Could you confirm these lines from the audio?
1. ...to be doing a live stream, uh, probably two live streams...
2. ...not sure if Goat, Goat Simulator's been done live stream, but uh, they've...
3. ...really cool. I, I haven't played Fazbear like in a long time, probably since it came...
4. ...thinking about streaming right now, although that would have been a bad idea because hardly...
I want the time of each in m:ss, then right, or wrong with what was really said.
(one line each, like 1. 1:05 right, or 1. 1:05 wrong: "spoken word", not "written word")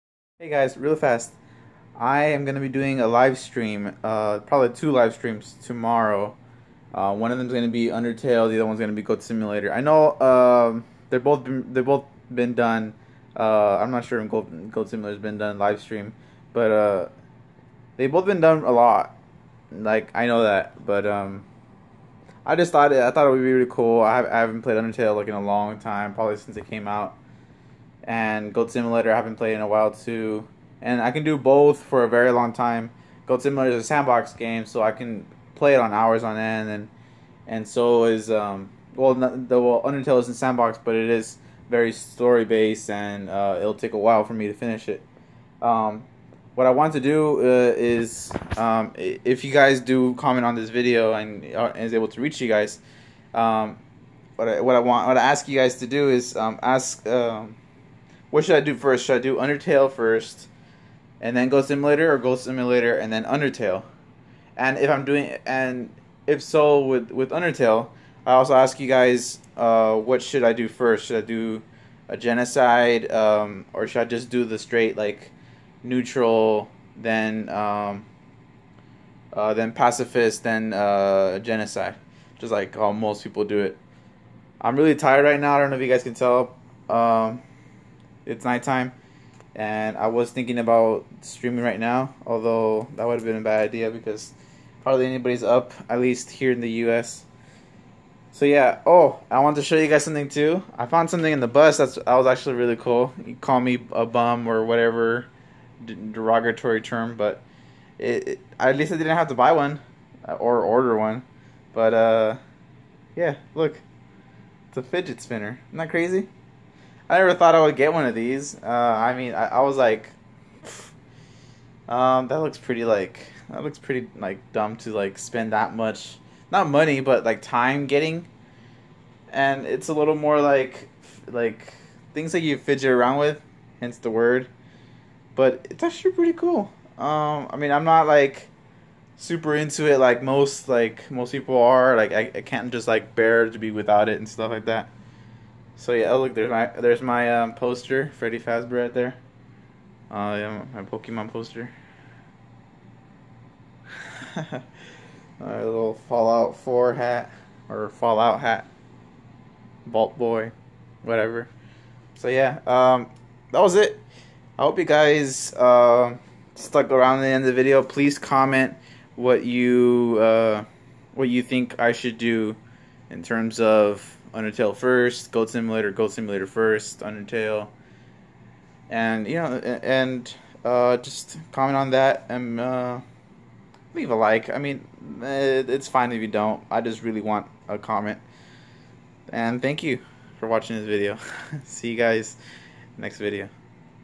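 1. 0:02 right
2. 0:13 right
3. 0:23 wrong: "Undertale", not "Fazbear"
4. 1:30 right.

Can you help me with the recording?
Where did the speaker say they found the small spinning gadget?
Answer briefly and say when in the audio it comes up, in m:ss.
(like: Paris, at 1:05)
the bus, at 1:41.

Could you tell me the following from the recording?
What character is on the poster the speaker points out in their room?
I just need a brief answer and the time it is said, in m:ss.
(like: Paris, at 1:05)
Freddy Fazbear, at 2:28.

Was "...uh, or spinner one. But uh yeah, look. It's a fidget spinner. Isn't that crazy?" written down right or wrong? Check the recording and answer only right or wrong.
wrong.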